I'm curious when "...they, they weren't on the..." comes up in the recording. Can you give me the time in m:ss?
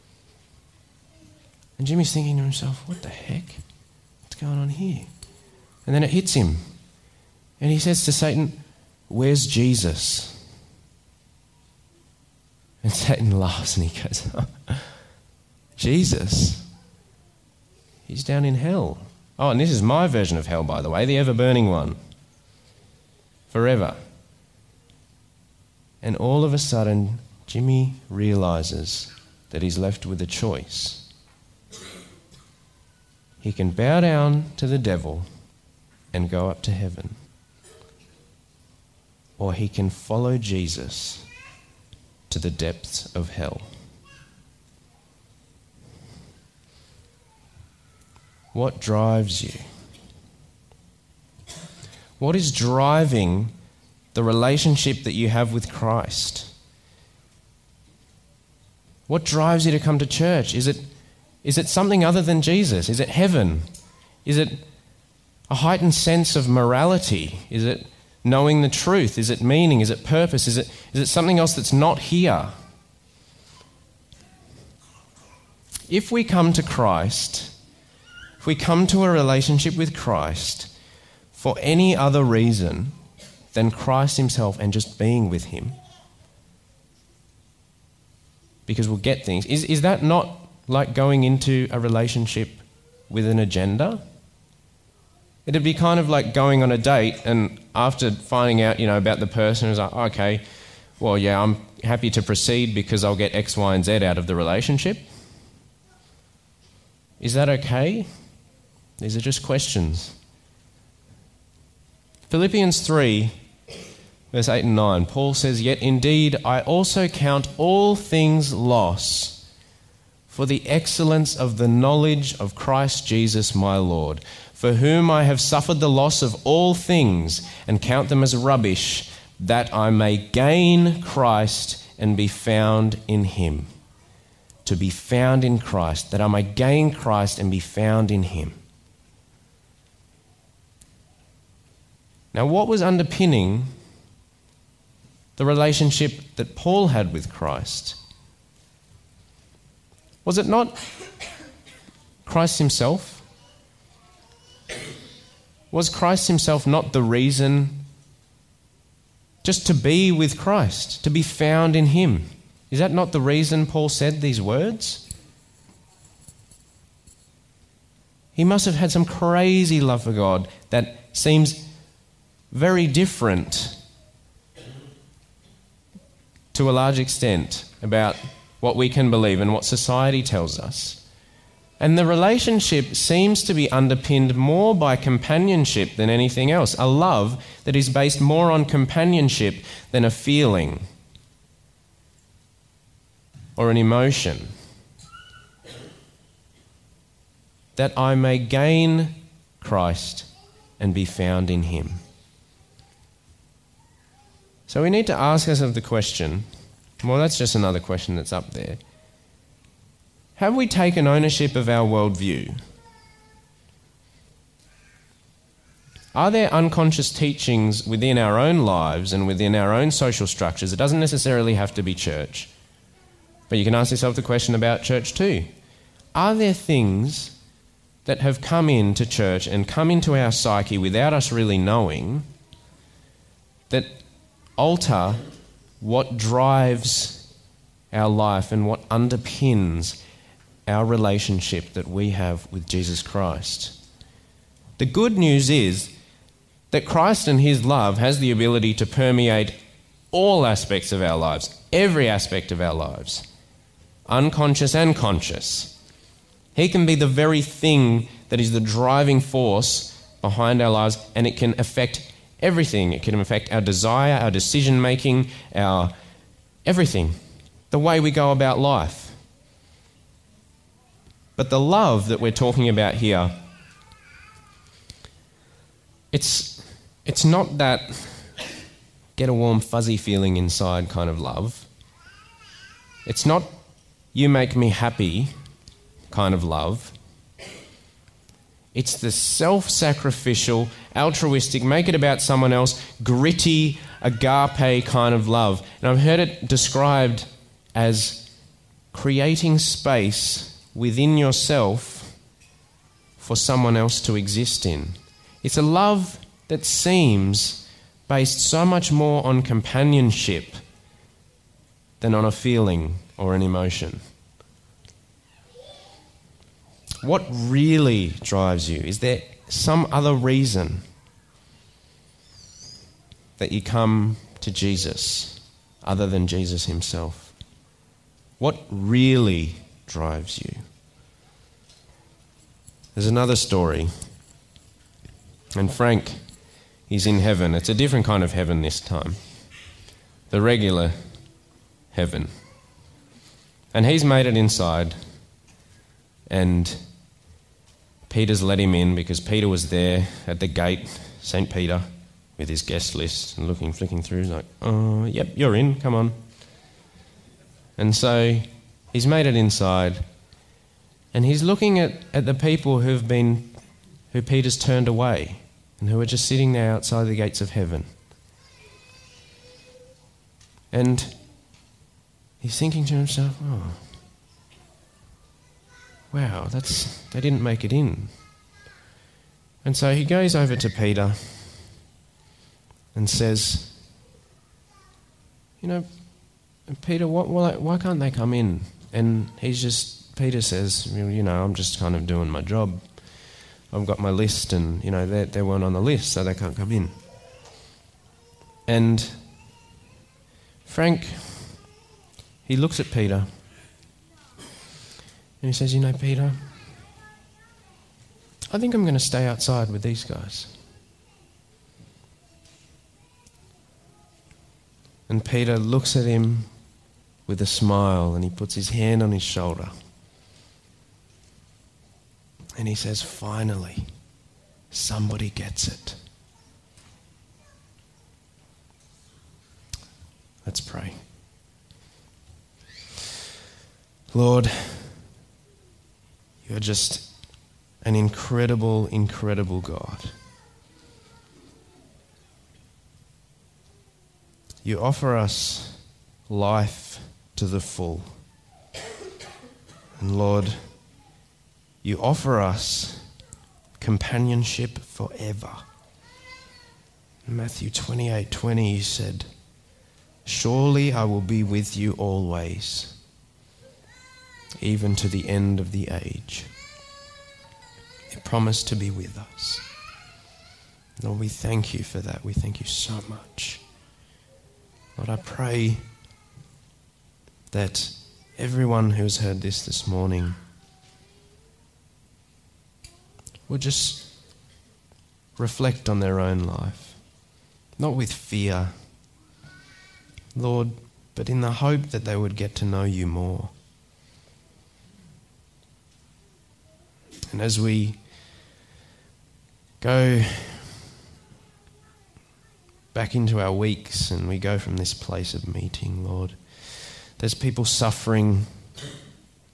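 6:35.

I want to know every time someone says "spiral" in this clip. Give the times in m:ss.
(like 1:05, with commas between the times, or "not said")
not said.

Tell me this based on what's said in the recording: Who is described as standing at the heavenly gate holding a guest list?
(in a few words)
St. Peter.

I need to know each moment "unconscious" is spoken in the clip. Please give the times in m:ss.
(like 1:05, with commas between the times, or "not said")
3:36, 4:14.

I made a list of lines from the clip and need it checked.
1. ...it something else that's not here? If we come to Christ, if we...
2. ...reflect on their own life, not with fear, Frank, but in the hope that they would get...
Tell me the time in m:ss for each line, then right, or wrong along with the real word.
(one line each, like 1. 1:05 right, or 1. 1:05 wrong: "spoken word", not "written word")
1. 1:11 right
2. 8:05 wrong: "Lord", not "Frank".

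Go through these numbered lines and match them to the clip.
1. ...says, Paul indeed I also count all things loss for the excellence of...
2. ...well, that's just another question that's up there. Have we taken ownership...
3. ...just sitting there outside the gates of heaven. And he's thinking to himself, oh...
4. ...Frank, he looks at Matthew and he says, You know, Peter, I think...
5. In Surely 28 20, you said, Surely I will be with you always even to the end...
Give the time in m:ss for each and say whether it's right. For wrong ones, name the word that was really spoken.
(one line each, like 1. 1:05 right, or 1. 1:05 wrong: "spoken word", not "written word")
1. 1:55 wrong: "Yet", not "Paul"
2. 3:27 right
3. 6:06 right
4. 6:40 wrong: "Peter", not "Matthew"
5. 7:37 wrong: "Matthew", not "Surely".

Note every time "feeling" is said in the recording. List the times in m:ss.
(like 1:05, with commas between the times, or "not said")
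3:10, 4:39, 5:12.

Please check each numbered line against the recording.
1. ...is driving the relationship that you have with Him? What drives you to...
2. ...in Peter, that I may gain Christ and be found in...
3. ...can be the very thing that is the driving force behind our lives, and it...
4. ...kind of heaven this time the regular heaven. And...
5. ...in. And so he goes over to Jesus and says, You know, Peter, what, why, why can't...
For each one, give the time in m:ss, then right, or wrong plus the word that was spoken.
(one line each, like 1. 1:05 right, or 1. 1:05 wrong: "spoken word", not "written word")
1. 0:52 wrong: "Christ", not "Him"
2. 2:15 wrong: "Christ", not "Peter"
3. 4:16 right
4. 5:38 right
5. 6:17 wrong: "Peter", not "Jesus".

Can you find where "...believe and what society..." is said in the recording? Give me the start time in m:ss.
2:59.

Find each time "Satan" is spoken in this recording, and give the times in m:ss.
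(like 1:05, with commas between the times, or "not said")
0:08, 0:12.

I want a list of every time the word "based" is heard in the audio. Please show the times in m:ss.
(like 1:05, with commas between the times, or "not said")
3:07, 5:08.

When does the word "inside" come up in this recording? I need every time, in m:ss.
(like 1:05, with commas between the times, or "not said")
4:40, 5:44, 5:59.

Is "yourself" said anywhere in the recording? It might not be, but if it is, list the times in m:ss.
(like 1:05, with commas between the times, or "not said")
3:43, 5:01.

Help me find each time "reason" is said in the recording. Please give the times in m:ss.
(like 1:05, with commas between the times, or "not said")
1:22, 2:37, 2:43, 5:20.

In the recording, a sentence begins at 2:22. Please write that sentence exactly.
Now, what was underpinning the relationship that Paul had with Christ?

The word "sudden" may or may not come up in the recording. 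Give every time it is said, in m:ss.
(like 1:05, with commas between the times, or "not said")
0:26.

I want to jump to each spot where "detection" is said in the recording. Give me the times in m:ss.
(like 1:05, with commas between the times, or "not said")
not said.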